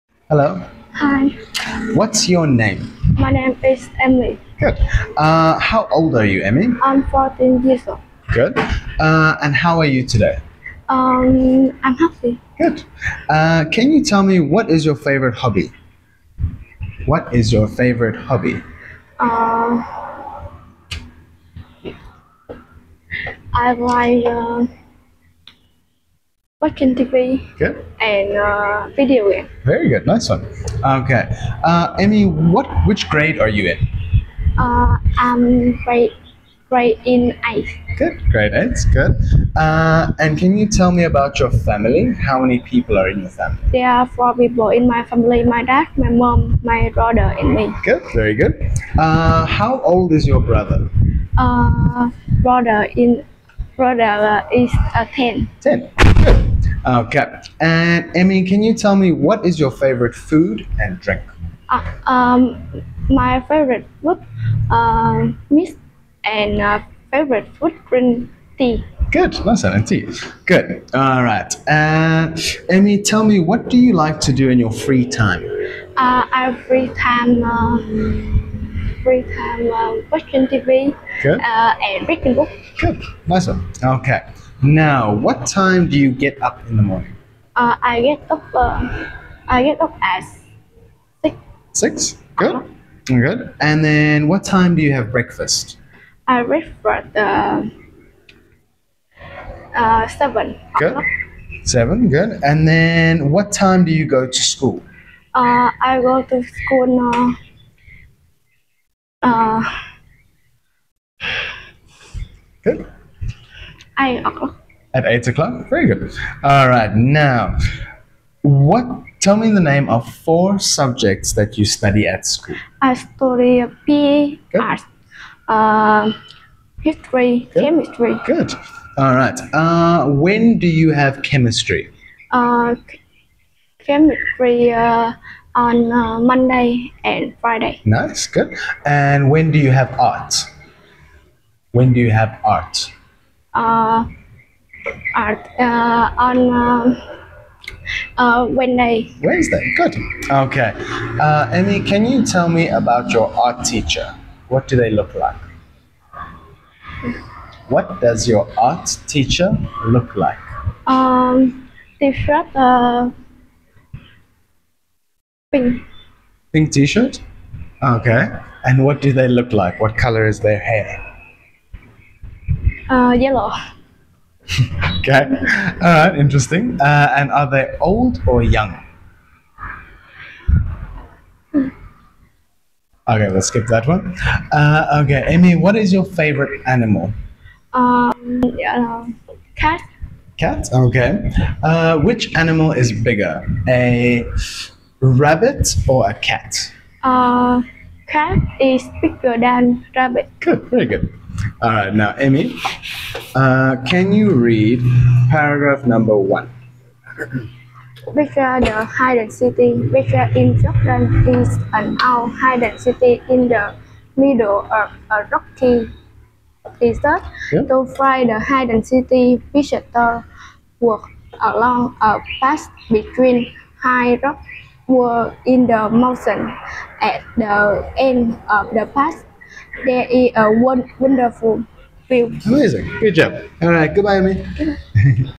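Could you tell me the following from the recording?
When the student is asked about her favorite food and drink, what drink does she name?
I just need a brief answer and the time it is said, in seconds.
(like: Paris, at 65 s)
green tea, at 67 s.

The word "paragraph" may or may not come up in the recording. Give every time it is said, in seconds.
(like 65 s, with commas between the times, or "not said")
205 s.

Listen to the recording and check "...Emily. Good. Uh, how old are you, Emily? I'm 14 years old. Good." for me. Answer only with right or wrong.
right.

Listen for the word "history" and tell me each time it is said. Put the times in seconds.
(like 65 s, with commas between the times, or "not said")
126 s.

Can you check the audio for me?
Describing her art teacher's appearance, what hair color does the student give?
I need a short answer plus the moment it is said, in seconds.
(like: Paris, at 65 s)
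yellow, at 173 s.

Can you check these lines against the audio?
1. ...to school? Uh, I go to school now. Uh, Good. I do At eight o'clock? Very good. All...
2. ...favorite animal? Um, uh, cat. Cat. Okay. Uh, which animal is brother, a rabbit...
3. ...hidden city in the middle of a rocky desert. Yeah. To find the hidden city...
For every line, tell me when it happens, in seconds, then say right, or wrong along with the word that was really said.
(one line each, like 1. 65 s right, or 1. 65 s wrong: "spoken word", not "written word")
1. 104 s right
2. 186 s wrong: "bigger", not "brother"
3. 212 s right.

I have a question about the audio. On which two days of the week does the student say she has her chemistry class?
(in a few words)
Monday and Friday.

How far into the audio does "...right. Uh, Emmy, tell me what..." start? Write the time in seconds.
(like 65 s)
71 s.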